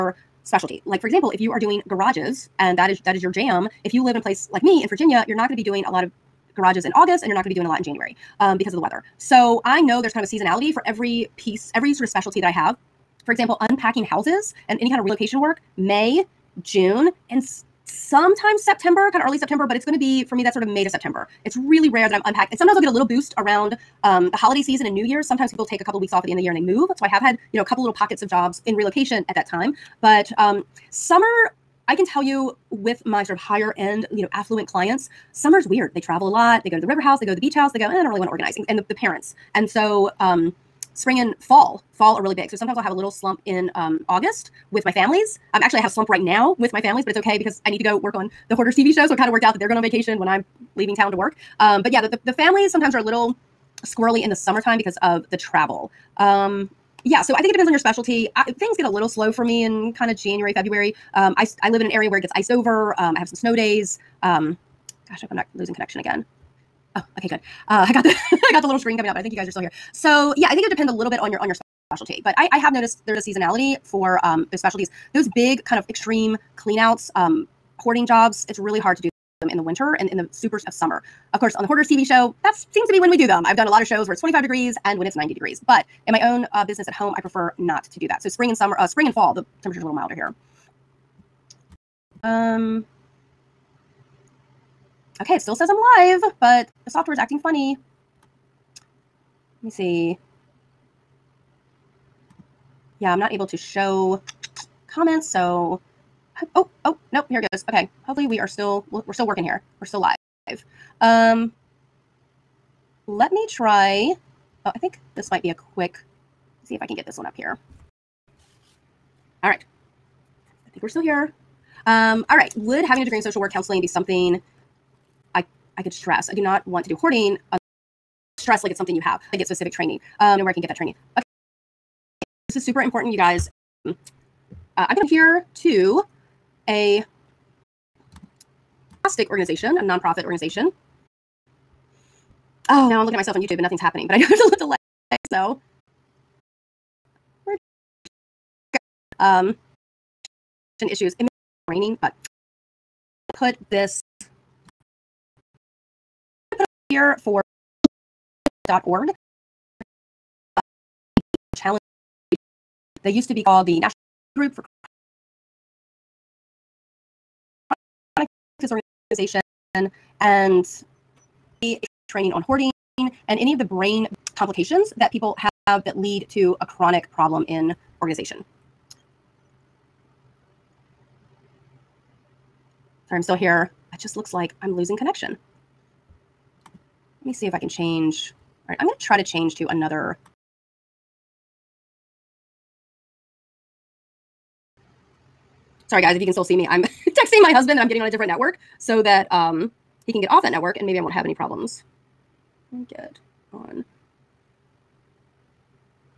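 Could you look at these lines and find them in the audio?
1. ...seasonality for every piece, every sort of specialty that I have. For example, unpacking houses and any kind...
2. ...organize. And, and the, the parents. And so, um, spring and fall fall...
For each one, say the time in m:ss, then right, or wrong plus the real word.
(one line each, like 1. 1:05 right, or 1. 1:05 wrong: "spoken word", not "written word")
1. 0:10 right
2. 0:38 right.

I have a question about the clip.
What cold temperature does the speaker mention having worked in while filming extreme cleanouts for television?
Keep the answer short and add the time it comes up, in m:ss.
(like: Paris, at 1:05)
25 degrees, at 1:24.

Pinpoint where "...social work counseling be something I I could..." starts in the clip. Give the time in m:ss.
2:03.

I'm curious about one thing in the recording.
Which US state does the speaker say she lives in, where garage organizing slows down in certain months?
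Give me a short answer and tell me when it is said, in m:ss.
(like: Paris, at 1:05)
Virginia, at 0:04.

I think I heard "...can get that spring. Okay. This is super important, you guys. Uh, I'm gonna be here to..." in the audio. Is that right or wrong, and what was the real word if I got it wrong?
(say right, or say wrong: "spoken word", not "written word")
wrong: "training", not "spring".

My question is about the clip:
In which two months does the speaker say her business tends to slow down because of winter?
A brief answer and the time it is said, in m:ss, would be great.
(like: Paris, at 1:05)
January, February, at 1:00.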